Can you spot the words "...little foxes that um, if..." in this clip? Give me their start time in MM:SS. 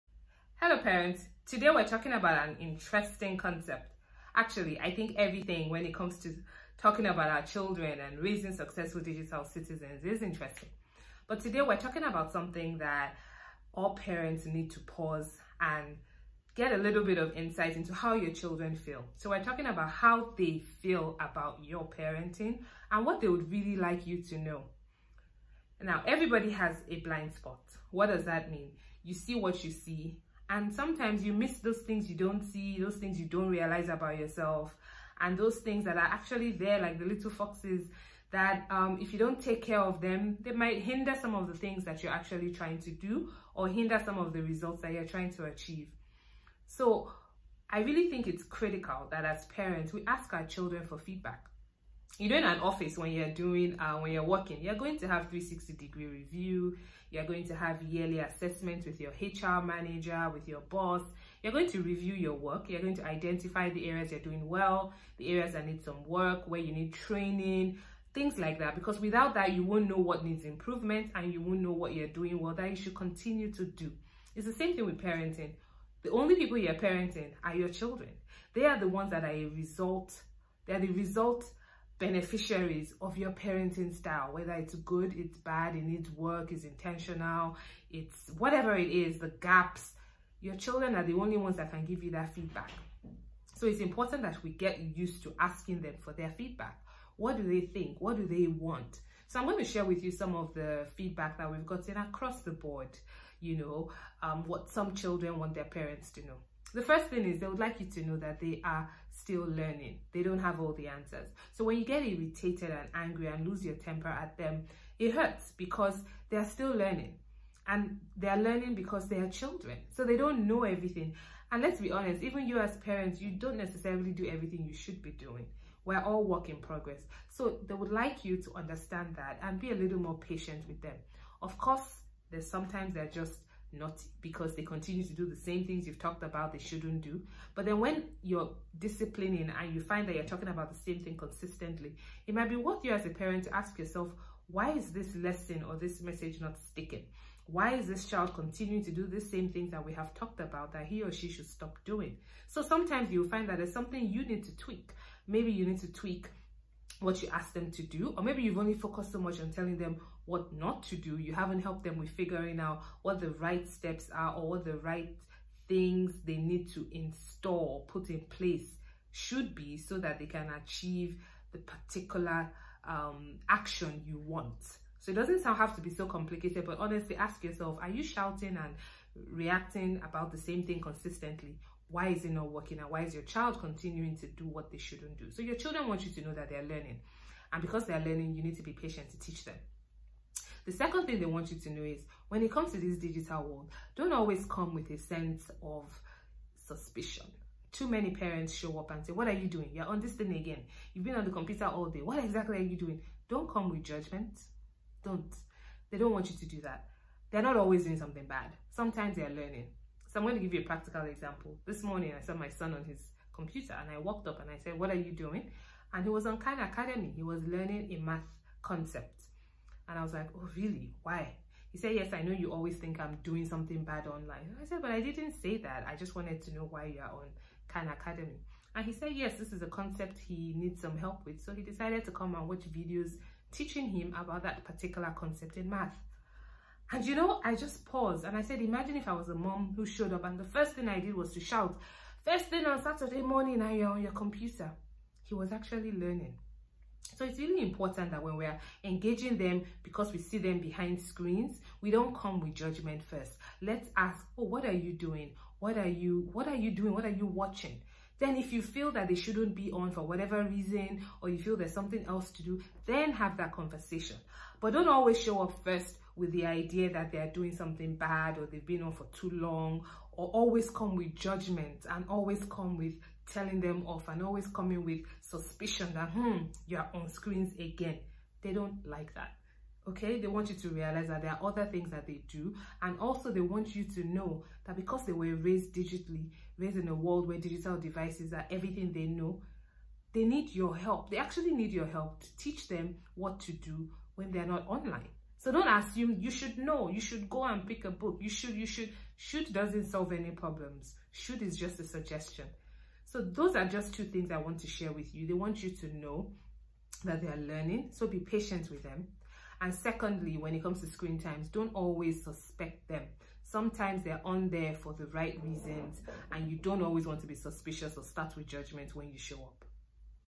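00:37.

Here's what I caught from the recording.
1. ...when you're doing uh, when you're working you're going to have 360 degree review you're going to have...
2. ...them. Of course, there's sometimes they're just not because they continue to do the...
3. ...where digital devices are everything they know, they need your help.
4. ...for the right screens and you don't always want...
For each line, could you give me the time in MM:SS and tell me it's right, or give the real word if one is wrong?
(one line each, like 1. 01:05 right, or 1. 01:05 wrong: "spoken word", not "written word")
1. 00:52 right
2. 02:10 right
3. 04:47 right
4. 05:14 wrong: "reasons", not "screens".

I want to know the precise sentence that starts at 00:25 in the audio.
Now, everybody has a blind spot.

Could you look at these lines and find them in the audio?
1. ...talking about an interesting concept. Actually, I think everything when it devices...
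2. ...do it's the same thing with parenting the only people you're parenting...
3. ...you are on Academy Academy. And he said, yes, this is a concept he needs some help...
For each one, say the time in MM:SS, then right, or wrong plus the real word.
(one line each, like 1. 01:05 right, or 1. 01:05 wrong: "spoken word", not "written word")
1. 00:01 wrong: "comes", not "devices"
2. 01:13 right
3. 03:46 wrong: "Khan", not "Academy".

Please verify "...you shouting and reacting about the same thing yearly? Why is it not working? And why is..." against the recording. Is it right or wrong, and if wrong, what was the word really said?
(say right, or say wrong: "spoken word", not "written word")
wrong: "consistently", not "yearly".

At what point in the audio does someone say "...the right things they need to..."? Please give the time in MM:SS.
02:44.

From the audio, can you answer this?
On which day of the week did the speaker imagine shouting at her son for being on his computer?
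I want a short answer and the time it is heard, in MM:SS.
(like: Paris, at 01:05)
Saturday, at 04:02.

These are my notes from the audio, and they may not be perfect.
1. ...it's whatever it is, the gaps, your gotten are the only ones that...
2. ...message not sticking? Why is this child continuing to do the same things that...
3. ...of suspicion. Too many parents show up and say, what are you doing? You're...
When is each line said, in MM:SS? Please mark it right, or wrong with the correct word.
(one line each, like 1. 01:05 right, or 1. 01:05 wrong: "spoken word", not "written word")
1. 01:27 wrong: "children", not "gotten"
2. 02:26 right
3. 03:15 right.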